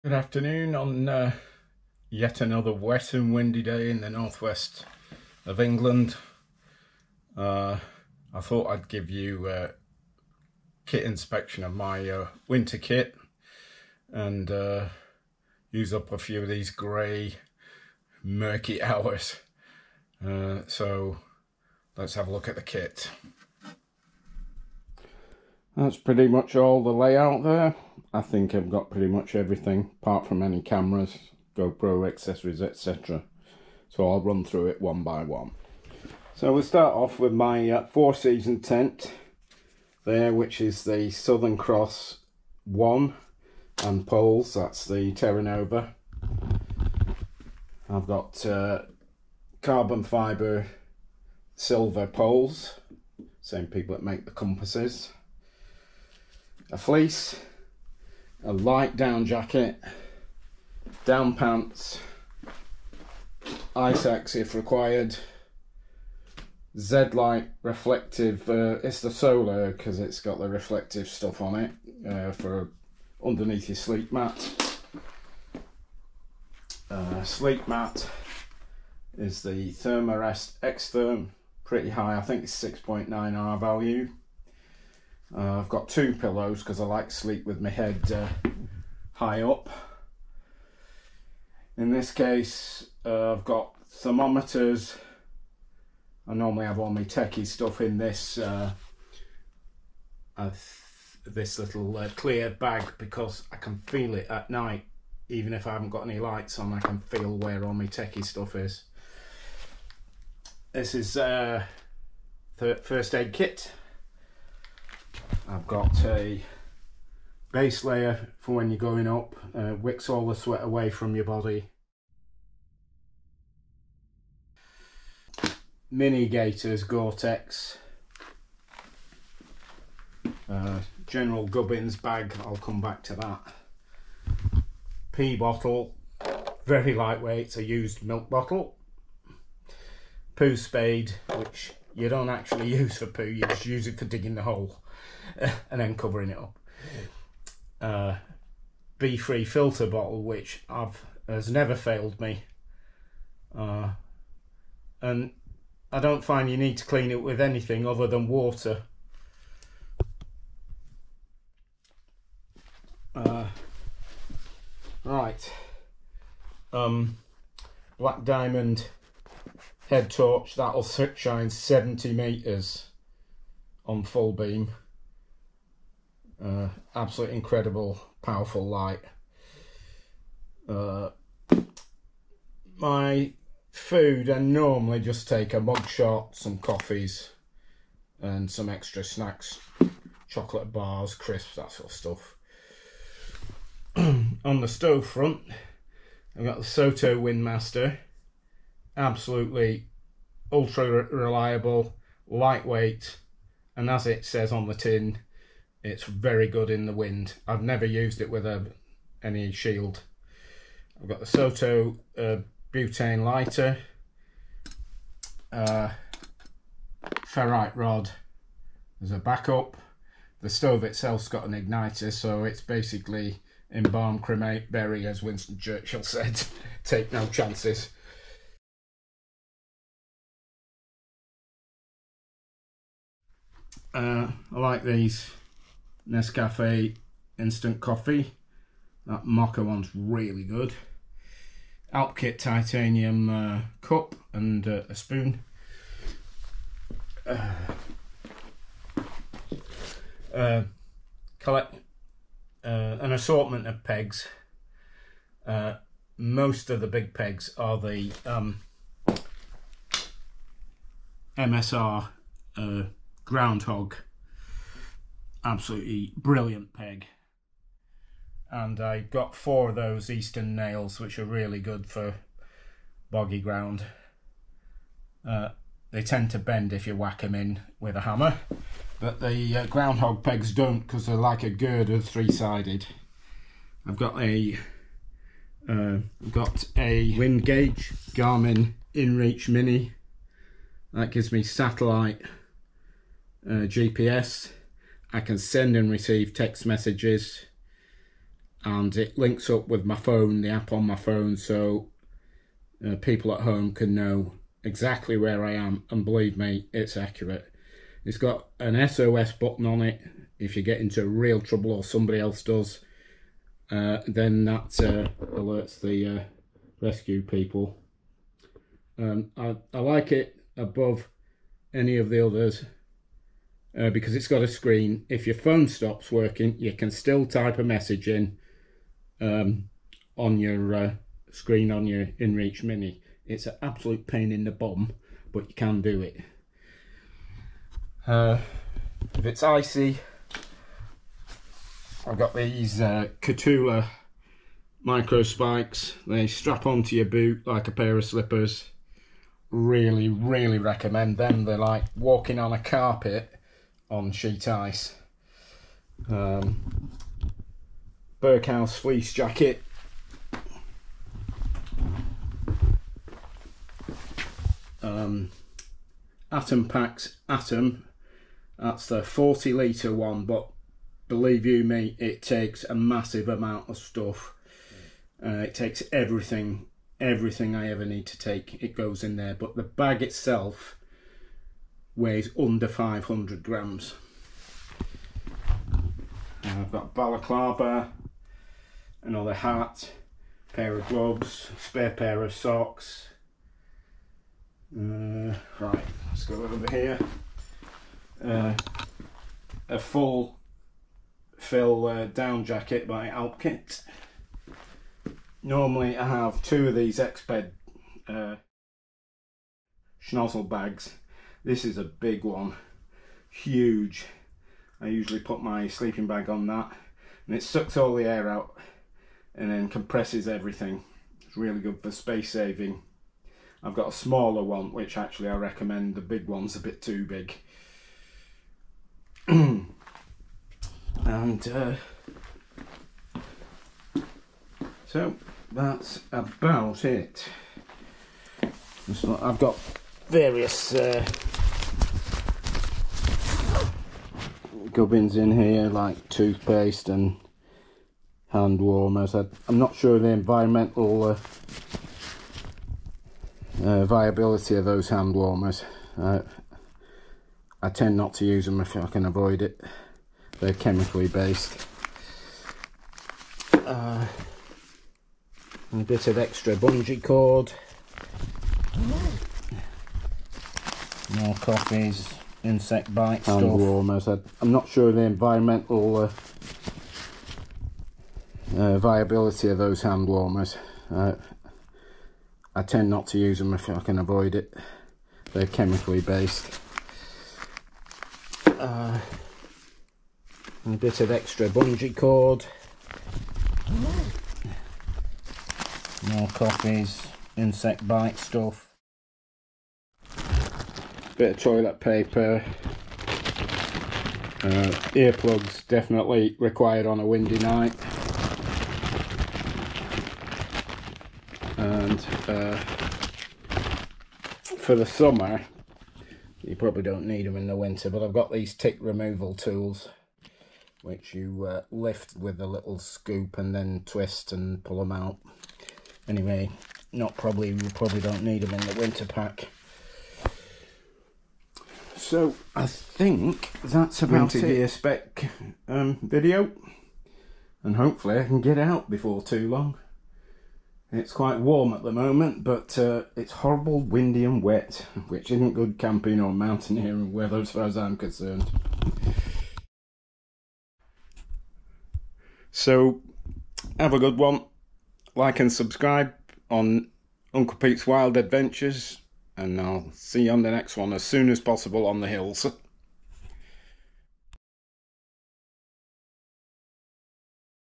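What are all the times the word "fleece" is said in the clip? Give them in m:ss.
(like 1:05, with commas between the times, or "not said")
0:56, 5:58.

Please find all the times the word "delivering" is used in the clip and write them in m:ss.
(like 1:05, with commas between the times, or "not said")
not said.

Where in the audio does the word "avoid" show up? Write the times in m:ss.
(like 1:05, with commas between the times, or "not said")
7:39, 8:03.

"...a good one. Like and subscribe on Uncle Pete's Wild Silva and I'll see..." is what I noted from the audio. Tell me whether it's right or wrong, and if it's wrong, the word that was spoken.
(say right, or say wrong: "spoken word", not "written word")
wrong: "Adventures", not "Silva".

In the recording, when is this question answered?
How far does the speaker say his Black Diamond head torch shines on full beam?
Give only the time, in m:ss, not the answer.
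2:51.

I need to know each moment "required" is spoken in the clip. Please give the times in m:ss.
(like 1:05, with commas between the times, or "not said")
1:04, 8:26.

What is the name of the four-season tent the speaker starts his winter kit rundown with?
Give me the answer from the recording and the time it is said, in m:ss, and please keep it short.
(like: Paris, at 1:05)
Southern Cross 1, at 0:41.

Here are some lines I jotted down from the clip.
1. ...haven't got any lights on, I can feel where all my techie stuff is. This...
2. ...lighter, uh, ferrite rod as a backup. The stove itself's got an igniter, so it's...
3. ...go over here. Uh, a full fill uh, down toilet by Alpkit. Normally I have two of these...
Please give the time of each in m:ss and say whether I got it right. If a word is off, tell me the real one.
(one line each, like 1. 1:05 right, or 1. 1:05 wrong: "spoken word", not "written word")
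1. 1:45 right
2. 3:33 right
3. 6:36 wrong: "jacket", not "toilet".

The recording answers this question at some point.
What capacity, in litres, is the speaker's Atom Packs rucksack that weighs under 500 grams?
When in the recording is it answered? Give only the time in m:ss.
6:09.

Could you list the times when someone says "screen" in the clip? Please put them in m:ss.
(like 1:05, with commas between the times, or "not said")
5:24, 5:31.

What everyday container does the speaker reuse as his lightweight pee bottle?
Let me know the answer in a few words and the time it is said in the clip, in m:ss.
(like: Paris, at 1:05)
milk bottle, at 2:18.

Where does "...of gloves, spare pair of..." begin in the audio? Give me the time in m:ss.
6:30.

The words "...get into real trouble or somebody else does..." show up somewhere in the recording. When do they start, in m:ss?
5:10.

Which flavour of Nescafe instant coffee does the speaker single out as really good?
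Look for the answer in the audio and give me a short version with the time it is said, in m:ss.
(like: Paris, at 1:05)
mocha, at 3:59.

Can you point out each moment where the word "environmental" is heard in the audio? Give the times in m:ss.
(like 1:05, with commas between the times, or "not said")
7:30, 7:55.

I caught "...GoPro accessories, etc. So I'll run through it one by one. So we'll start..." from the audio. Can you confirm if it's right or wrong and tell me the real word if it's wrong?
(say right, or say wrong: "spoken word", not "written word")
right.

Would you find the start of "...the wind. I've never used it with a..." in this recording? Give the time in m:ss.
3:26.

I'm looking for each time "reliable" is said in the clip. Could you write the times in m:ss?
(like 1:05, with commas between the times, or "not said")
3:21.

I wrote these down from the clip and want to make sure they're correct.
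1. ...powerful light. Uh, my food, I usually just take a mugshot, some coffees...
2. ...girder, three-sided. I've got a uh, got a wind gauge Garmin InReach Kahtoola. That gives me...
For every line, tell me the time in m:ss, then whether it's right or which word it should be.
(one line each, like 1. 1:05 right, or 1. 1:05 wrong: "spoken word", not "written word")
1. 2:58 wrong: "normally", not "usually"
2. 4:41 wrong: "Mini", not "Kahtoola".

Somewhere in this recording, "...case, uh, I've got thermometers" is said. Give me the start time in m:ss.
1:32.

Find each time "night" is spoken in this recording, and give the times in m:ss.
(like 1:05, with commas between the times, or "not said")
1:44, 8:27.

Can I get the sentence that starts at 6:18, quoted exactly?
It goes in there, but the bag itself weighs under 500 grams.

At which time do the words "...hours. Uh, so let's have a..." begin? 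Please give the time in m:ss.
0:18.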